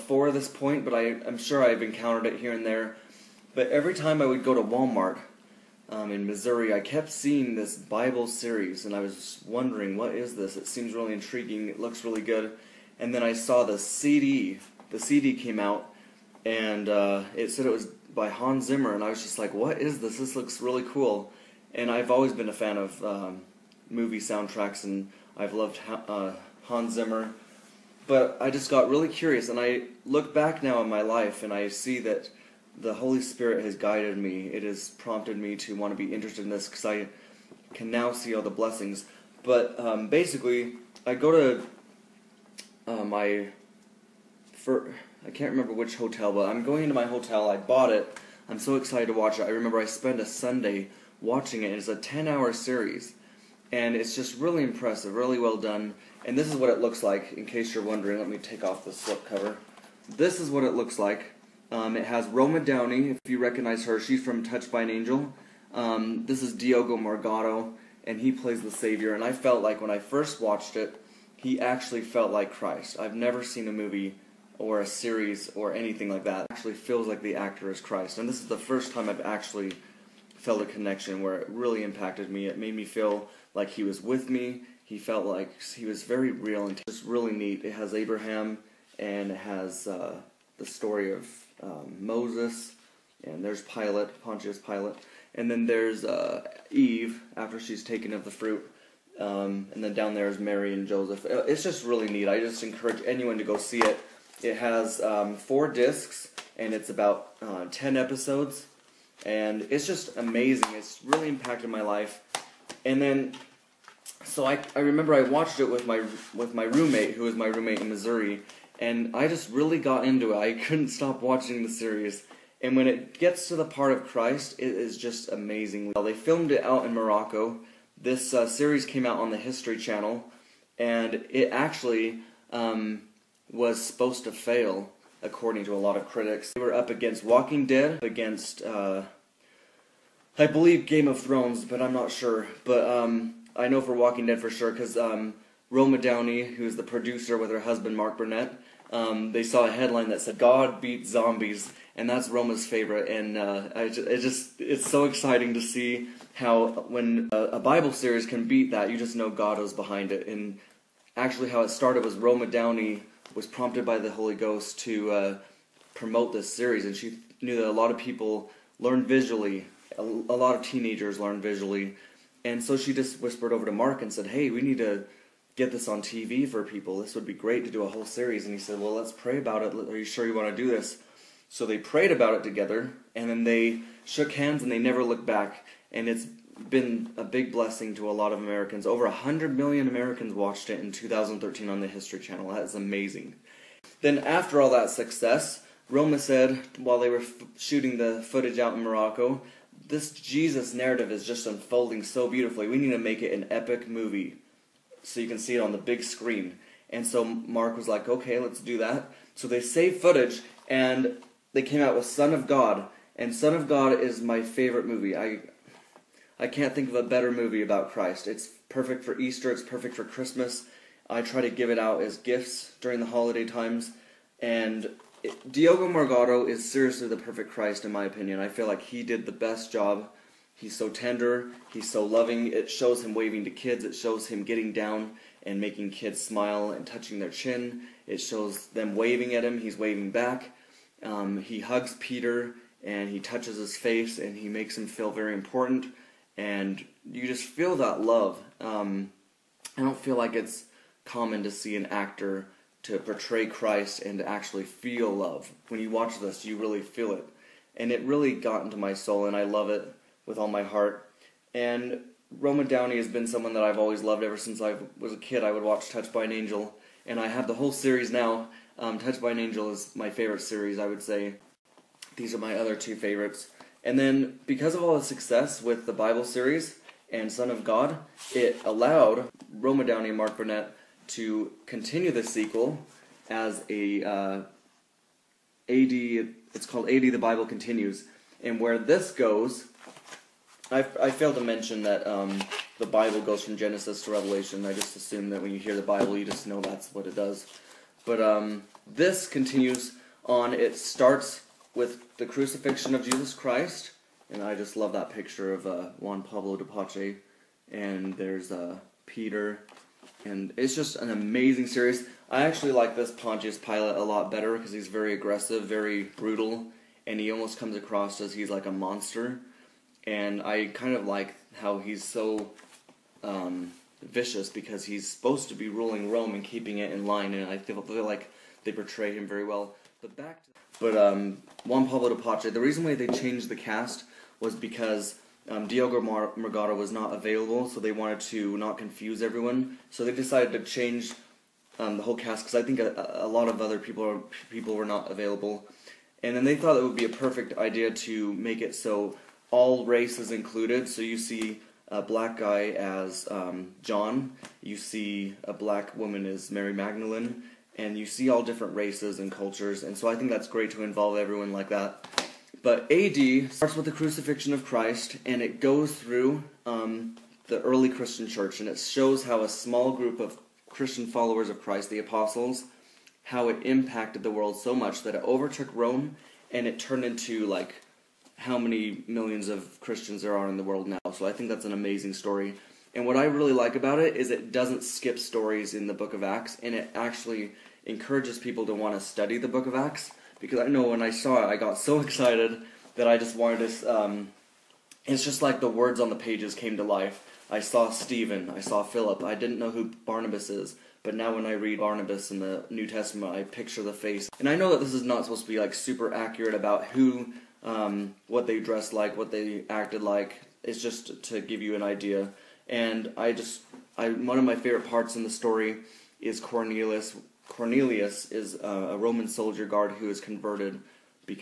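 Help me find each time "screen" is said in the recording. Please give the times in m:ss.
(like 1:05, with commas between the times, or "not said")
3:26.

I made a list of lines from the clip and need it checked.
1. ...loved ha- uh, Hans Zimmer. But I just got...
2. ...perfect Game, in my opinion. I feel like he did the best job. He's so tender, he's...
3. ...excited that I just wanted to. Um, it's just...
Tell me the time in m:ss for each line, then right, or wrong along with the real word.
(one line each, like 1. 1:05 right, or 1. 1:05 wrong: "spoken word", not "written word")
1. 0:25 right
2. 3:47 wrong: "Christ", not "Game"
3. 6:32 right.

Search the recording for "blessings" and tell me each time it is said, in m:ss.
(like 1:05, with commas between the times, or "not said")
0:38, 3:07.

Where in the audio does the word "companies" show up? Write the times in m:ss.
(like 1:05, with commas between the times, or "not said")
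not said.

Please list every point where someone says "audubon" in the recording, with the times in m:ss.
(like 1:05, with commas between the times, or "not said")
not said.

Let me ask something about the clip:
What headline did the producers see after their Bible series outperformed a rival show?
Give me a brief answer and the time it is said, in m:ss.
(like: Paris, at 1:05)
God beat zombies, at 2:30.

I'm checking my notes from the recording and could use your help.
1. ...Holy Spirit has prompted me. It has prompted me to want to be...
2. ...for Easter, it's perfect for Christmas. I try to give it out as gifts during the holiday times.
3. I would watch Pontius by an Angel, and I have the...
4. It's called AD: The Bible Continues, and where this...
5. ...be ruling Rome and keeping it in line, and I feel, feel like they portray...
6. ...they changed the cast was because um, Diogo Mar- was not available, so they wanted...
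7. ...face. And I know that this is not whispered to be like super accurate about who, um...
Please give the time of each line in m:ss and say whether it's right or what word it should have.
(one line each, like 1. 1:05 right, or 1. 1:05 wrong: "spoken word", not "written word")
1. 0:32 wrong: "guided", not "prompted"
2. 3:39 right
3. 4:25 wrong: "Touched", not "Pontius"
4. 4:45 right
5. 5:25 right
6. 5:32 right
7. 6:43 wrong: "supposed", not "whispered".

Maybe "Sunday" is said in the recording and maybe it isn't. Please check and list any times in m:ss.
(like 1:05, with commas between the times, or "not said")
0:50.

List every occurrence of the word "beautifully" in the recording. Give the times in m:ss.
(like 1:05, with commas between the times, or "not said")
3:22.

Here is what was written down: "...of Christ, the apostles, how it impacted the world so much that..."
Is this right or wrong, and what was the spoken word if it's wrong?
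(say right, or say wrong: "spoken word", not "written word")
right.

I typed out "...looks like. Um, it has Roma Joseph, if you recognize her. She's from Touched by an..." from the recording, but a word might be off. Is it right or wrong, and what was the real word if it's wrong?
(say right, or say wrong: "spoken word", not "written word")
wrong: "Downey", not "Joseph".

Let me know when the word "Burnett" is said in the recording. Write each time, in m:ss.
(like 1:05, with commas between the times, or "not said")
2:28, 4:40.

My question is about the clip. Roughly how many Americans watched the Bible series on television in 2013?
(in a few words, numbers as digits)
Over 100 million.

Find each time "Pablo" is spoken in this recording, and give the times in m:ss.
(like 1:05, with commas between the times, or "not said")
5:06, 5:31.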